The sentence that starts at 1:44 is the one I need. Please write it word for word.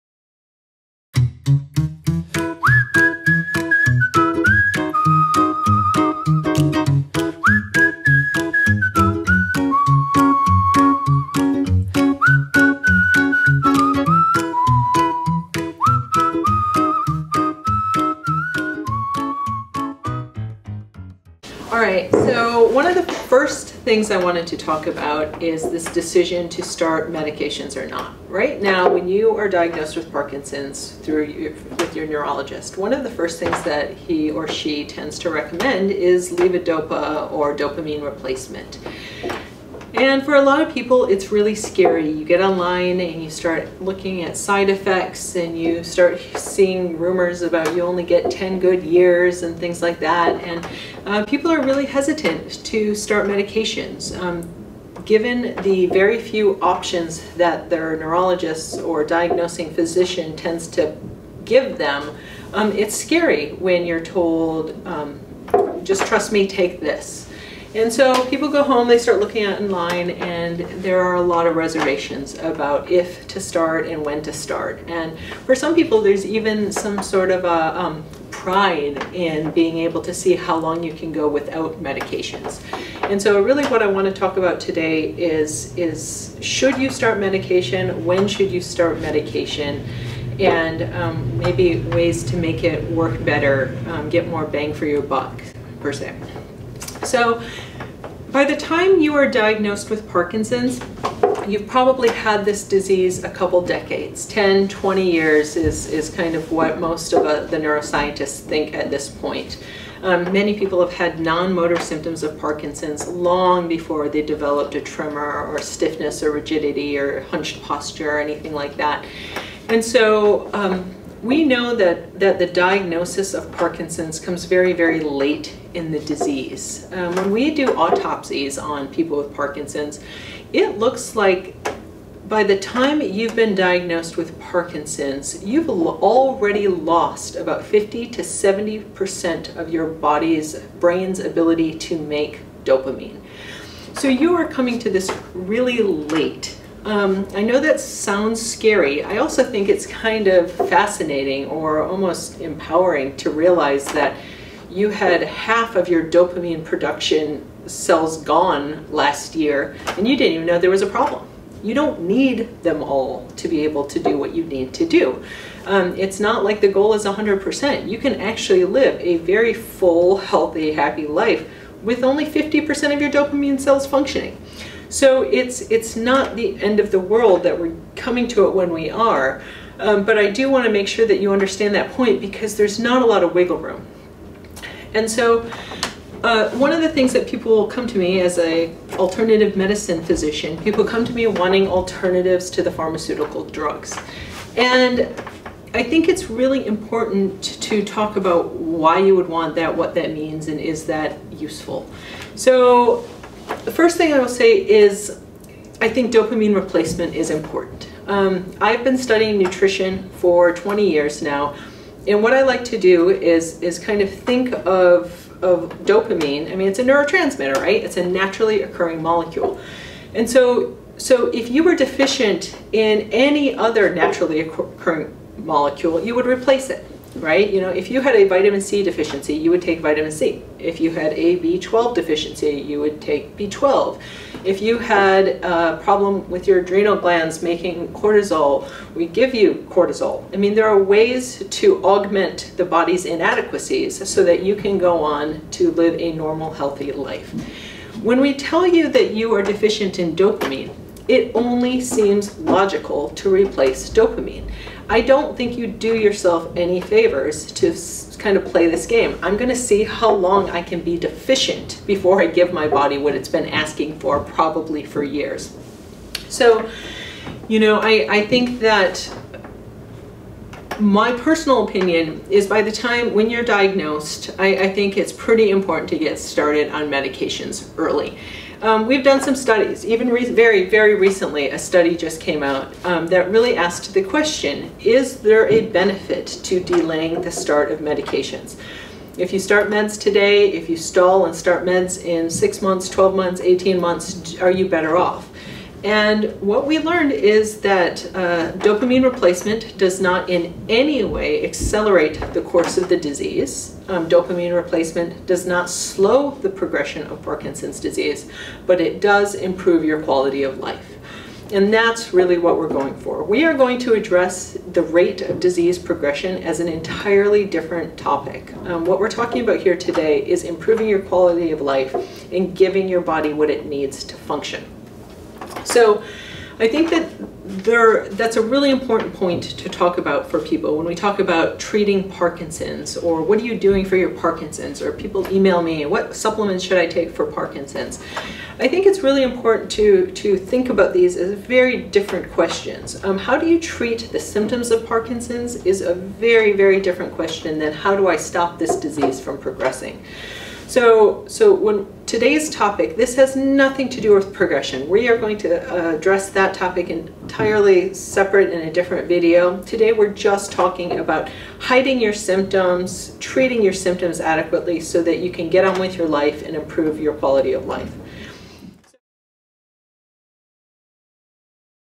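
10, 20 years is, is kind of what most of a, uh, the neuroscientists think at this point.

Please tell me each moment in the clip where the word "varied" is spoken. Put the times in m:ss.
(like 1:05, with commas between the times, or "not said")
not said.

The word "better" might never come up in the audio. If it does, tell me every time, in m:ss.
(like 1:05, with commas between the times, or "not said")
1:33, 4:54.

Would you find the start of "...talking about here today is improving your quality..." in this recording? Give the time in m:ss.
5:19.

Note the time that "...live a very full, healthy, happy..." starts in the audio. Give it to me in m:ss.
2:48.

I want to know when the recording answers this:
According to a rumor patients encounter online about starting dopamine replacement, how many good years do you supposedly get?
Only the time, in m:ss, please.
0:48.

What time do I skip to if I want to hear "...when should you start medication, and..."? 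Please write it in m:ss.
1:28.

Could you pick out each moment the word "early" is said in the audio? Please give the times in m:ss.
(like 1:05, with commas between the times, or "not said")
4:37.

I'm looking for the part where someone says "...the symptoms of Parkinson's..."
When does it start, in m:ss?
5:44.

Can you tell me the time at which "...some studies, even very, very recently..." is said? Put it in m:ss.
4:39.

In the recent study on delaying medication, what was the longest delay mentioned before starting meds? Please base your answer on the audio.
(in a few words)
18 months.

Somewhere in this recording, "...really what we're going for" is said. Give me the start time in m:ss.
5:12.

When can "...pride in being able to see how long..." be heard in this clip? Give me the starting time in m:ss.
1:18.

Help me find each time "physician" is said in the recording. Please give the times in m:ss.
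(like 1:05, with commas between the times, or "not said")
0:59, 3:10.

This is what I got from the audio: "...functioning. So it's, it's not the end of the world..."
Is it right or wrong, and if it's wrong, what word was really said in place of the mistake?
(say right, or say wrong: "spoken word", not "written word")
right.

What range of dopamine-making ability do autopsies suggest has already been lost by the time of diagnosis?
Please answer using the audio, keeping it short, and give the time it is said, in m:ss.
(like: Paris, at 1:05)
50 to 70%, at 2:17.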